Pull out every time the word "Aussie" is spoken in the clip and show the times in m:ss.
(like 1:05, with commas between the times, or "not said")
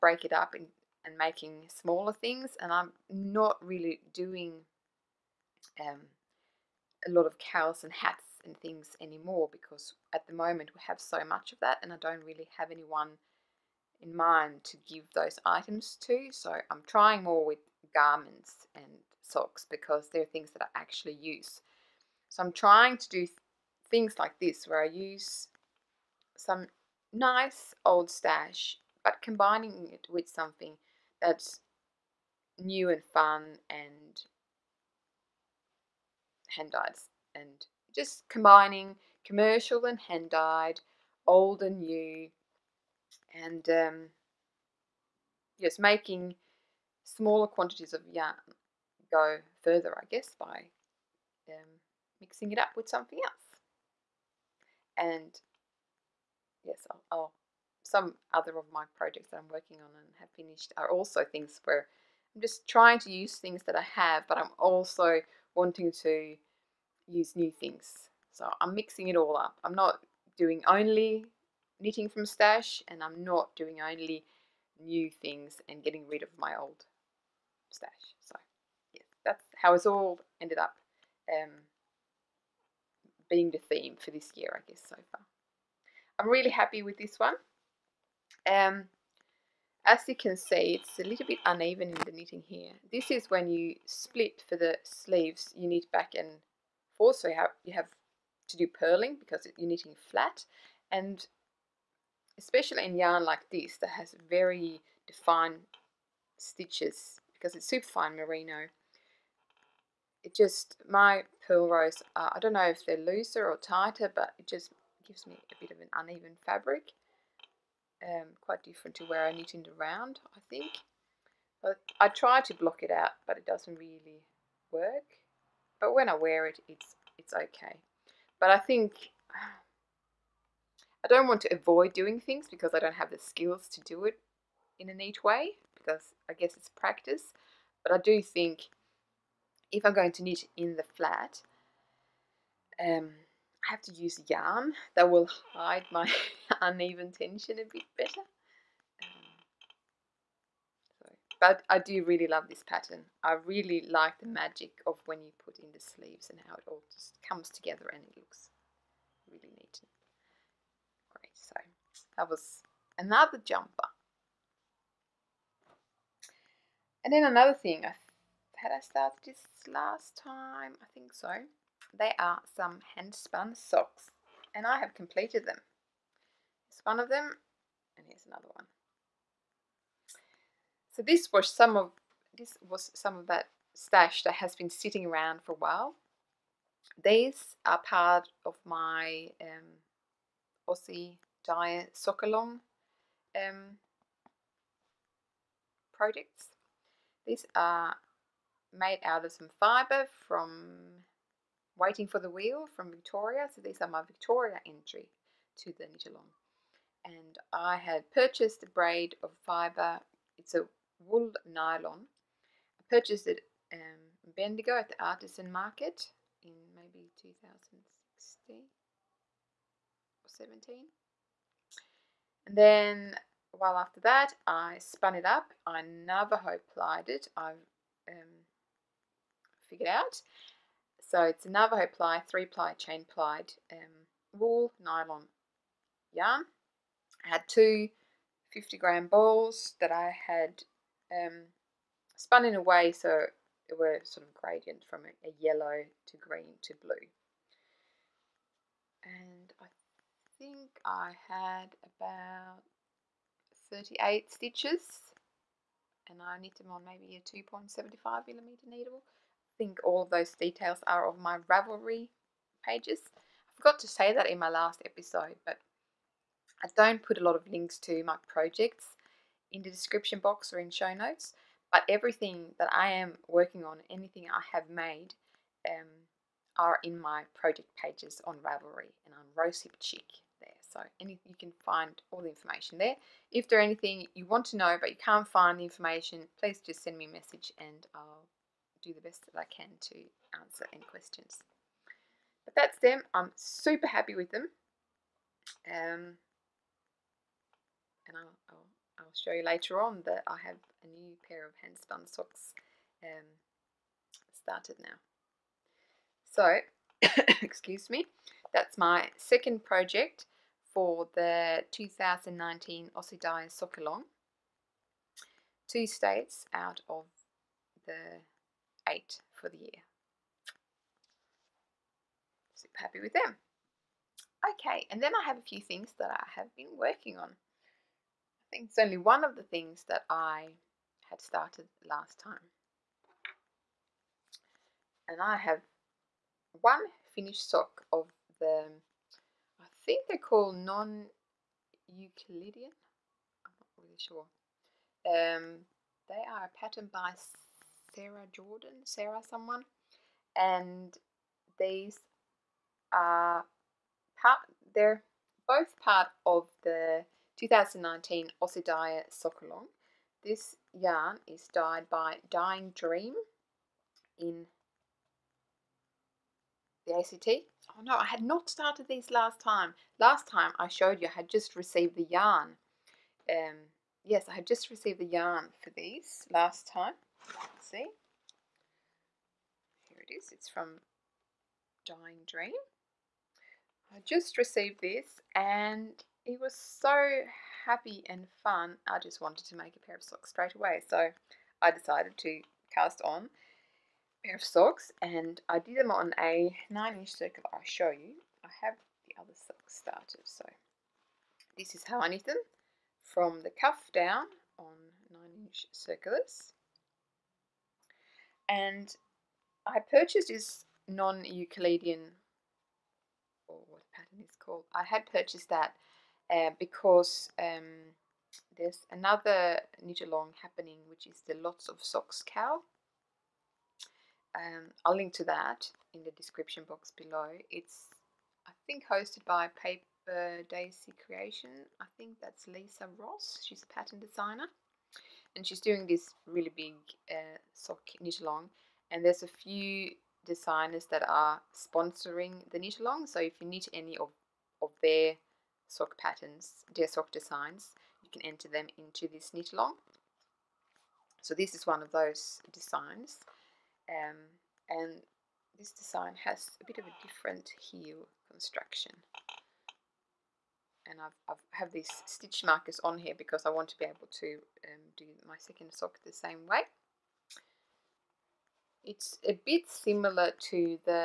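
3:10, 5:12, 5:58.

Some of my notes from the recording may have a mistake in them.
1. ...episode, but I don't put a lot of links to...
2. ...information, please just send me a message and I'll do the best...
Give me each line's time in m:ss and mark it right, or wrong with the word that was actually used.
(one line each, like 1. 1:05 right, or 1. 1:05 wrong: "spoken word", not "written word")
1. 4:24 right
2. 4:45 right.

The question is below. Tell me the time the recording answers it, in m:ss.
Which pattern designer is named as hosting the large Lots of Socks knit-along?
7:12.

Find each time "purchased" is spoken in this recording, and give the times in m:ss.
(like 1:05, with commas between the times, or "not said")
3:28, 3:32, 6:49, 6:55.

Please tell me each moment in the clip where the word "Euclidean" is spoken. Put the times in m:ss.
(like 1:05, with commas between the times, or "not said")
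5:41, 6:50.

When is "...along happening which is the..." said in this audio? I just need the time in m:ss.
7:00.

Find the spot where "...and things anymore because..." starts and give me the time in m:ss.
0:08.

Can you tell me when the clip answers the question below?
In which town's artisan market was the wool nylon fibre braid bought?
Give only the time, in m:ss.
3:34.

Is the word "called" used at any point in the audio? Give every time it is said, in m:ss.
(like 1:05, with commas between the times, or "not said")
5:40, 6:54.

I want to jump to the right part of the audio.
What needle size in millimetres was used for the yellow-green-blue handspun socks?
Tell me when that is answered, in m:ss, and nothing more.
4:17.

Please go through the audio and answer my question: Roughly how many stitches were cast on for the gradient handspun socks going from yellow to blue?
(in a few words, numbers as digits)
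38.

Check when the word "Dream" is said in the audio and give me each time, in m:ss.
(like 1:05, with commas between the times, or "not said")
6:02, 6:22.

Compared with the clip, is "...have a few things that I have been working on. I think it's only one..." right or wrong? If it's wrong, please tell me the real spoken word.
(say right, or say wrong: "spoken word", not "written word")
right.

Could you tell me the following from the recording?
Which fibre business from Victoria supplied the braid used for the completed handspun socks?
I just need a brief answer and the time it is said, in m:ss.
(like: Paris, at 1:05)
Waiting for the Wheel, at 3:21.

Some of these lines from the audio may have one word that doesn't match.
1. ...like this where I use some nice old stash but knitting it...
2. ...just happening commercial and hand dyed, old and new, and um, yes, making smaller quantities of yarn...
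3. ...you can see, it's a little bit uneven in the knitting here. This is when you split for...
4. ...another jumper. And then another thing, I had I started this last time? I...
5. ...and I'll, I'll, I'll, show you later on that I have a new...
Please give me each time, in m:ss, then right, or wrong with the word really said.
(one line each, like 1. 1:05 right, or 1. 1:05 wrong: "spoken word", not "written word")
1. 0:24 wrong: "combining", not "knitting"
2. 0:37 wrong: "combining", not "happening"
3. 1:30 right
4. 2:42 right
5. 4:58 right.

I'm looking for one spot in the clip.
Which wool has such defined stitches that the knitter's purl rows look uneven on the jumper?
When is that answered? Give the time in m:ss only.
1:47.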